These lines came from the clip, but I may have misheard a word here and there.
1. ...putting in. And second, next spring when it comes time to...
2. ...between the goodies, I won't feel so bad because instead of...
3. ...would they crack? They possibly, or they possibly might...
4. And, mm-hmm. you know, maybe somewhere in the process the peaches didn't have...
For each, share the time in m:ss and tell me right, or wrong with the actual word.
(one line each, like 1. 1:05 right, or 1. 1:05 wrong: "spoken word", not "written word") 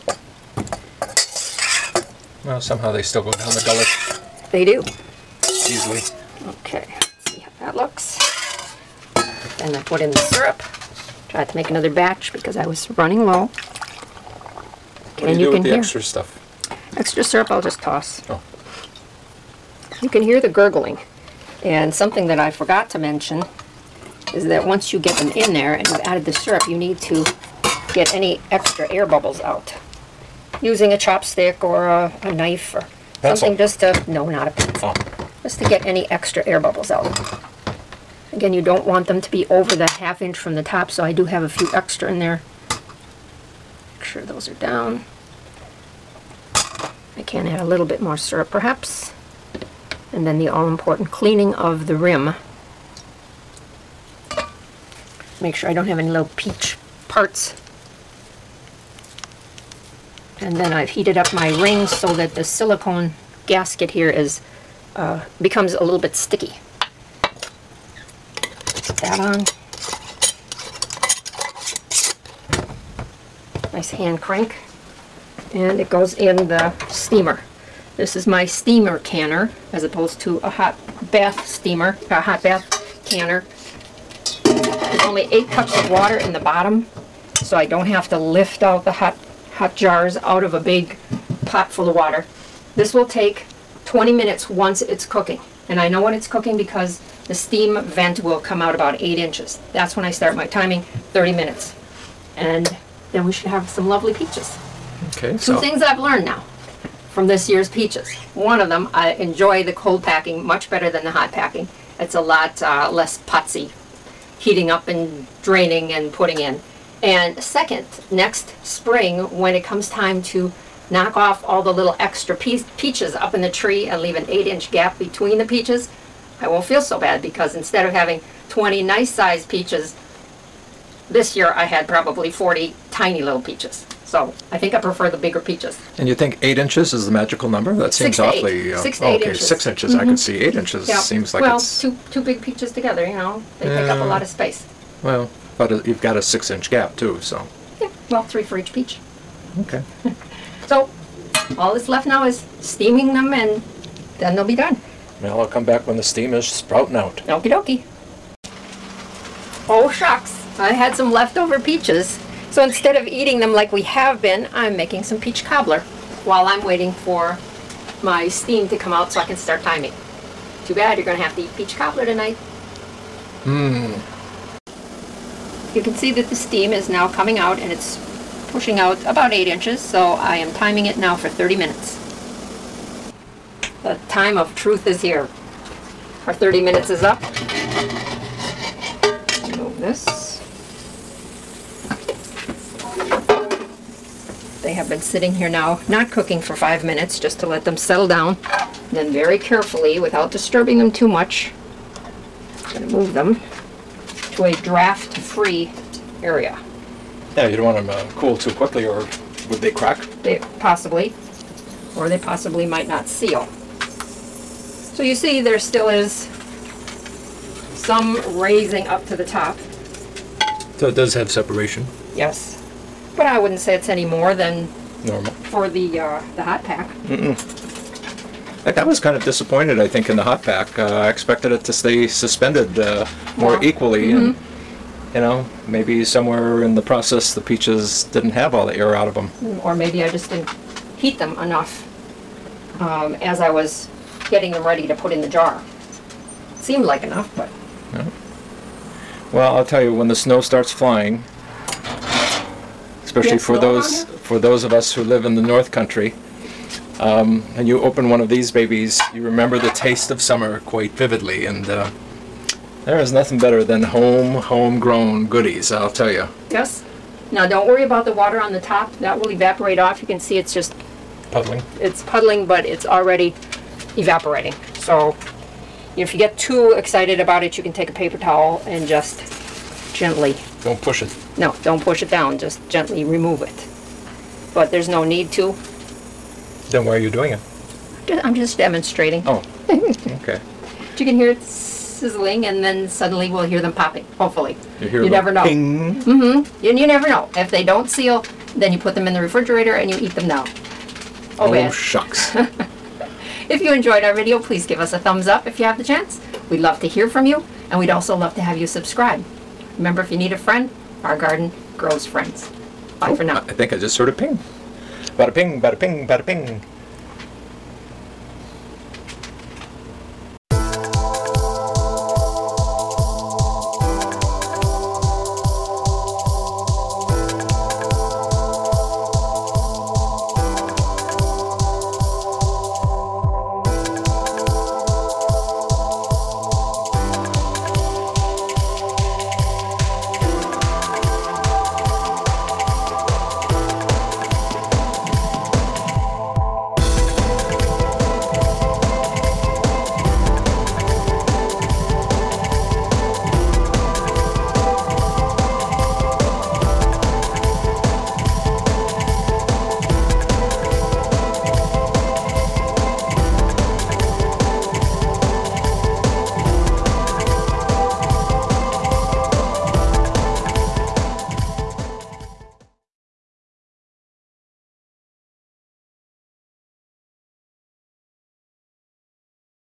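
1. 1:56 right
2. 2:04 wrong: "peaches", not "goodies"
3. 3:29 right
4. 3:54 right.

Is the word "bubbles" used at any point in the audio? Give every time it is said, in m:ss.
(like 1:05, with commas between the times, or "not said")
0:29, 0:36.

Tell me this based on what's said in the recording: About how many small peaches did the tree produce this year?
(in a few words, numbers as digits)
40.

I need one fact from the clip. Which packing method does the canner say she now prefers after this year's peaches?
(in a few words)
cold packing.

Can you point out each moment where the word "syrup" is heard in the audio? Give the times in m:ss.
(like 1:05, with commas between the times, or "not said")
0:10, 0:17, 0:26, 0:48.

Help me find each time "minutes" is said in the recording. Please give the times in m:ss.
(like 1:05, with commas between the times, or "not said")
1:34, 1:41, 3:01, 3:06, 3:16.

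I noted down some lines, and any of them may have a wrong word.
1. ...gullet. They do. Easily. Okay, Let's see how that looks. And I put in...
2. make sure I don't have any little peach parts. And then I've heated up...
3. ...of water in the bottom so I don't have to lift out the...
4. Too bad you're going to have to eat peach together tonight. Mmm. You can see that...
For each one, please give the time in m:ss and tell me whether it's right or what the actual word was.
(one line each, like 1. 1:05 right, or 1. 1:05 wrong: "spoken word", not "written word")
1. 0:03 right
2. 0:55 right
3. 1:25 right
4. 2:50 wrong: "cobbler", not "together".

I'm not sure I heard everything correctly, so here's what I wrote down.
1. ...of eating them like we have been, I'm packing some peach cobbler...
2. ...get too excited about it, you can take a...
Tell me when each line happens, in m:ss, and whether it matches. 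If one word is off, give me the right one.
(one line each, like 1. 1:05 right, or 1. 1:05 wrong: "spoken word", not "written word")
1. 2:42 wrong: "making", not "packing"
2. 4:36 right.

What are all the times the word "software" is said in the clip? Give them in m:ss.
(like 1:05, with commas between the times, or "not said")
not said.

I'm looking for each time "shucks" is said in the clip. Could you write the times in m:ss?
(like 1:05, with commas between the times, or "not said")
2:39, 5:01.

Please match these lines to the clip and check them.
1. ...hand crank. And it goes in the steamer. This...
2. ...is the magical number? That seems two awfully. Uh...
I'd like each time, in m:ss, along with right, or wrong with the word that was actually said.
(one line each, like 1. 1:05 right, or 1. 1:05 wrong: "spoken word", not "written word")
1. 1:13 right
2. 2:16 wrong: "six", not "two".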